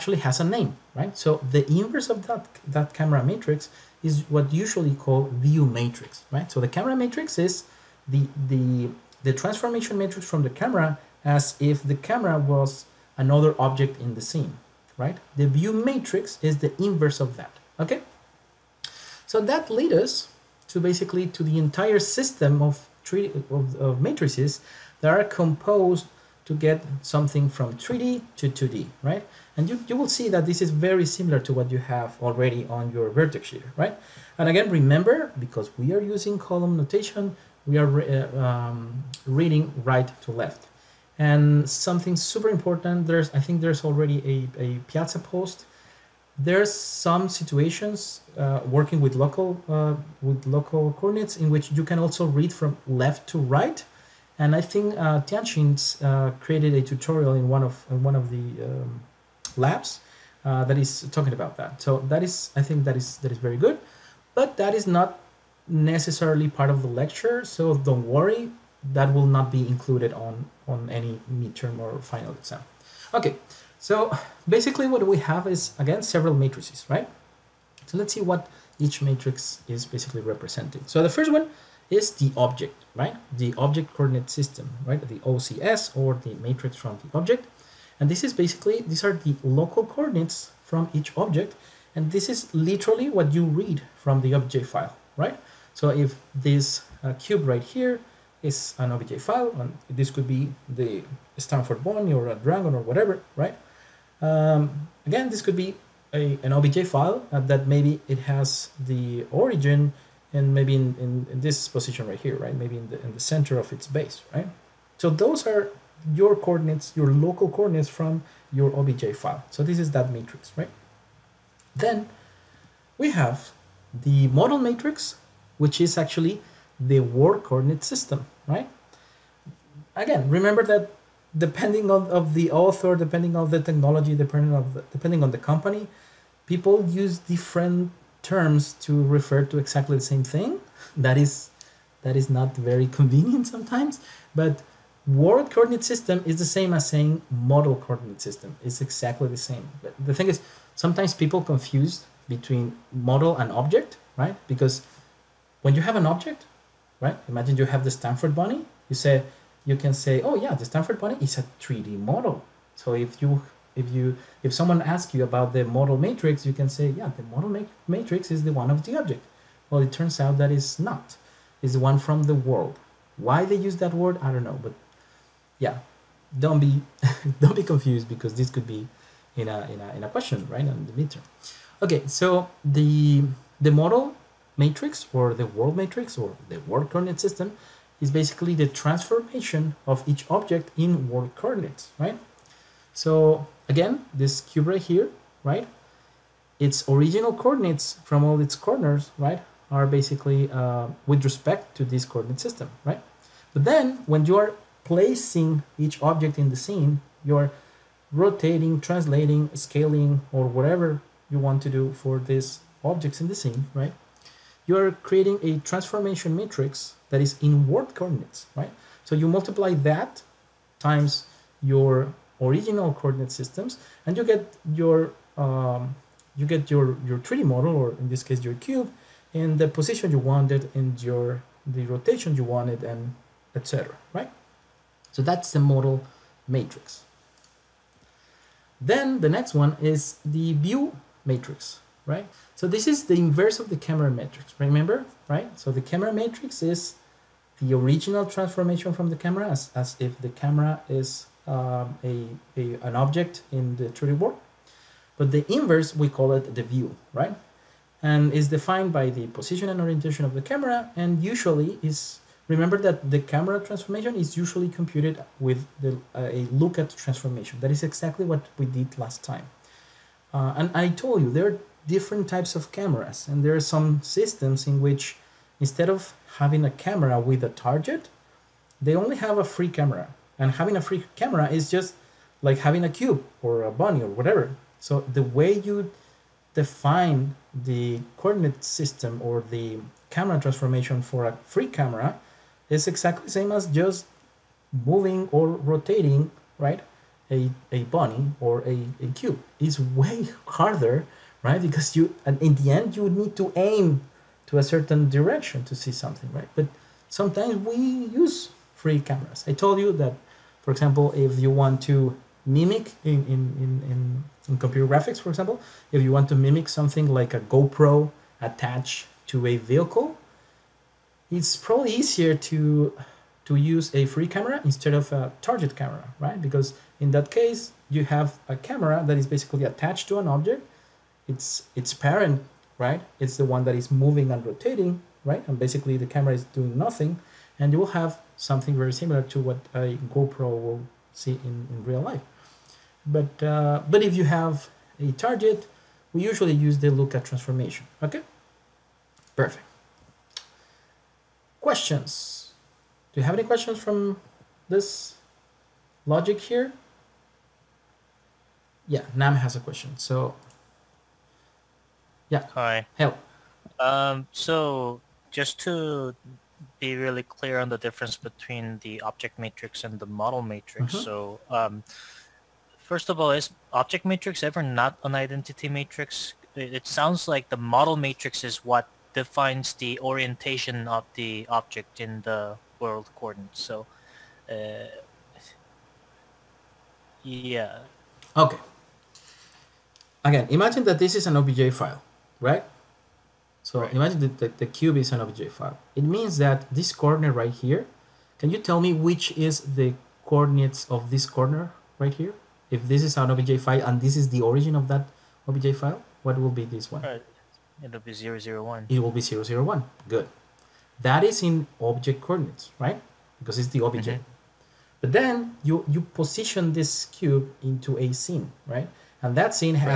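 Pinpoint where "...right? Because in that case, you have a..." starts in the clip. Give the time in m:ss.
5:26.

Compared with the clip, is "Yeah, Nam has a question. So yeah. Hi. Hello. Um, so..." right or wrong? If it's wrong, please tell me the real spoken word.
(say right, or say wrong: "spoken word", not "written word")
right.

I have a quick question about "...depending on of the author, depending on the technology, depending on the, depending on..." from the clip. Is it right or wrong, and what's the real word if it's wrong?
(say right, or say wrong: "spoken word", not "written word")
right.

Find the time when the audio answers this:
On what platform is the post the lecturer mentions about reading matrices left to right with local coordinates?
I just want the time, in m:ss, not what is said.
0:44.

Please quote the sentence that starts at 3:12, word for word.
So again, this cube right here, right?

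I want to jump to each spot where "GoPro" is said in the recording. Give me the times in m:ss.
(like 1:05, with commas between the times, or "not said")
5:17, 5:40.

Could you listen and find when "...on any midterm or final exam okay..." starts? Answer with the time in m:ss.
1:10.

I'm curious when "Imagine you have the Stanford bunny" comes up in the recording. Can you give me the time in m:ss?
2:37.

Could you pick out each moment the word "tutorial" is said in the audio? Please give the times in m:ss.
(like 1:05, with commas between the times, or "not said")
0:56.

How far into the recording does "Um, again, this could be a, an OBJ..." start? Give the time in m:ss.
1:44.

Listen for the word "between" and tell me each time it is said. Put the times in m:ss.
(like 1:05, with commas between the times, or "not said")
2:32, 6:08.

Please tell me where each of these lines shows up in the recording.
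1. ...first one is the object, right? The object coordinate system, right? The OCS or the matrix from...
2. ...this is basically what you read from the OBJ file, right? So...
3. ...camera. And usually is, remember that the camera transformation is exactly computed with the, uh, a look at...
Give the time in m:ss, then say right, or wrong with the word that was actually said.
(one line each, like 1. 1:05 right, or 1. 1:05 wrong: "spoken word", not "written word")
1. 1:21 right
2. 1:32 wrong: "literally", not "basically"
3. 4:20 wrong: "usually", not "exactly".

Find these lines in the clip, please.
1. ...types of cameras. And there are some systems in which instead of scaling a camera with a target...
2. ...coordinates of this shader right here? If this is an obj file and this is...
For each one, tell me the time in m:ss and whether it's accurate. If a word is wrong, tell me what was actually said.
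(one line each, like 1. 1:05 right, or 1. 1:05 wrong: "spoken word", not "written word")
1. 4:32 wrong: "having", not "scaling"
2. 6:40 wrong: "corner", not "shader".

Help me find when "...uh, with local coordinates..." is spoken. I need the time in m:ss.
0:49.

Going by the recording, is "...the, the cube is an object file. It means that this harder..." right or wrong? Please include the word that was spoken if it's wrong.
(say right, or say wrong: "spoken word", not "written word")
wrong: "corner", not "harder".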